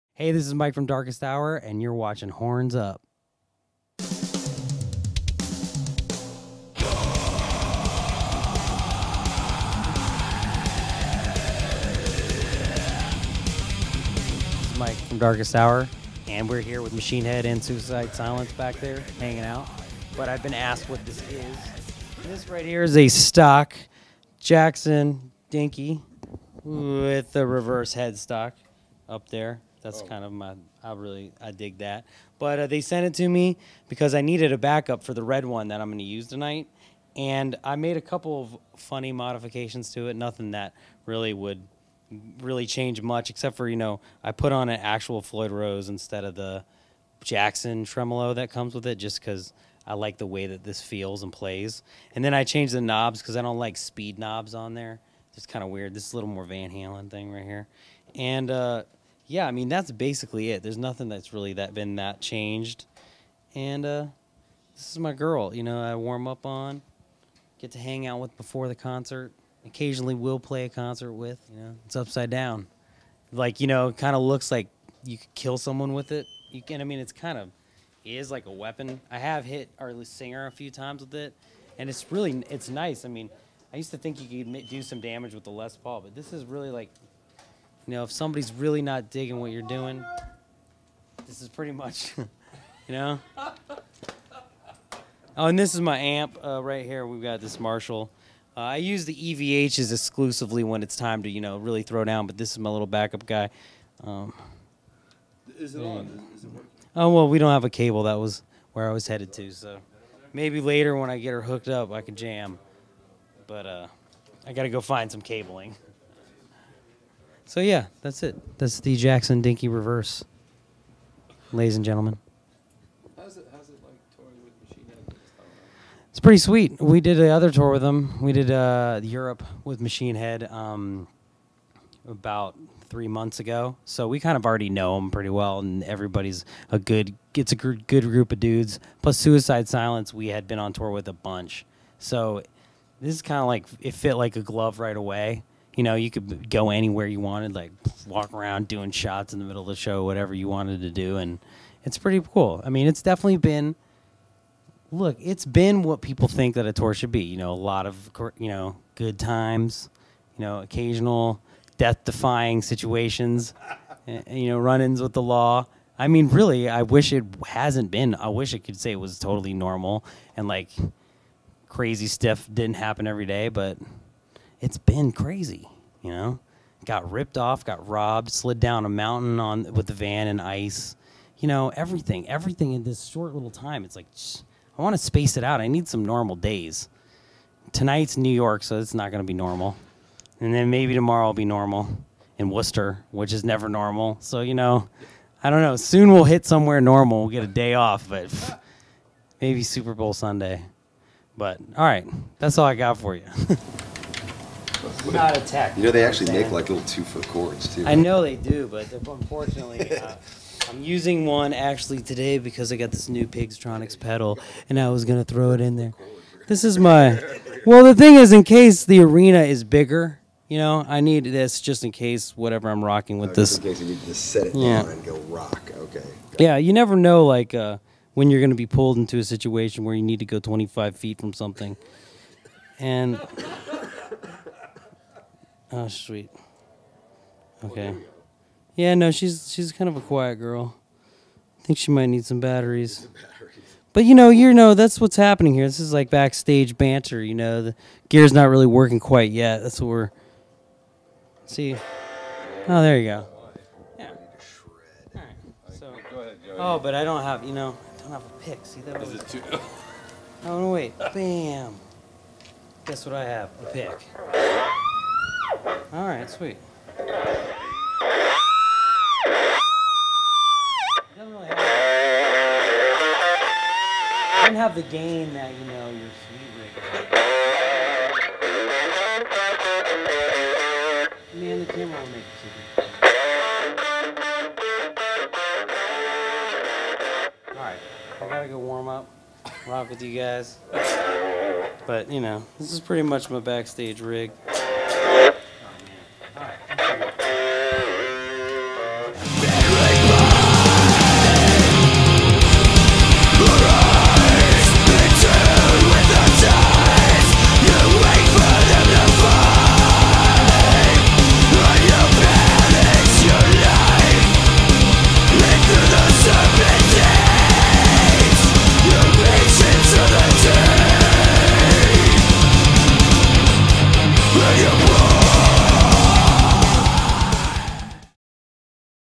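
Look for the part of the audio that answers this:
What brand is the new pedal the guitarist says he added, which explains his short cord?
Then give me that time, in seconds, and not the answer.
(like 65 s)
213 s.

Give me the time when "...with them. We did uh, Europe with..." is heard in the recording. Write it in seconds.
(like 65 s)
127 s.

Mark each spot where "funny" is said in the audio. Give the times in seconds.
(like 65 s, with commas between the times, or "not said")
38 s.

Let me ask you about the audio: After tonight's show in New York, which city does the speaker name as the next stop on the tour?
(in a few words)
Worcester.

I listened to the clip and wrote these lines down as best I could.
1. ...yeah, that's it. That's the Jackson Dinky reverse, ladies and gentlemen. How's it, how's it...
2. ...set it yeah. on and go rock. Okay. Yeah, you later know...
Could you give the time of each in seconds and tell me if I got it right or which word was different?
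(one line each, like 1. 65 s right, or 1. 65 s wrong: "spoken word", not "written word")
1. 117 s right
2. 224 s wrong: "never", not "later".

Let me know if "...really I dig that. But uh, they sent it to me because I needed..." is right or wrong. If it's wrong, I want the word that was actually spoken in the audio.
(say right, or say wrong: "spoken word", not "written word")
right.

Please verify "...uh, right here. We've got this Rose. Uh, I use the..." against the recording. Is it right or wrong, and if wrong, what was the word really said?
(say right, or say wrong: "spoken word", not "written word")
wrong: "Marshall", not "Rose".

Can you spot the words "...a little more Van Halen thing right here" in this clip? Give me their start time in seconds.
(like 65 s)
56 s.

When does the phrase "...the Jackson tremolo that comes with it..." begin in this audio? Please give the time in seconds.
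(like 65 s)
46 s.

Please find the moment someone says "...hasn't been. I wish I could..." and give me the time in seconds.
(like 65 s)
167 s.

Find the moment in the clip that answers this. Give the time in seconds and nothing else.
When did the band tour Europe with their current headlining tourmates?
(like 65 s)
132 s.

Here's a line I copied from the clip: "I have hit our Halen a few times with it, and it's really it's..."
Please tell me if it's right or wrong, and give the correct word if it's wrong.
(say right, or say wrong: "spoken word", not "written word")
wrong: "Singer", not "Halen".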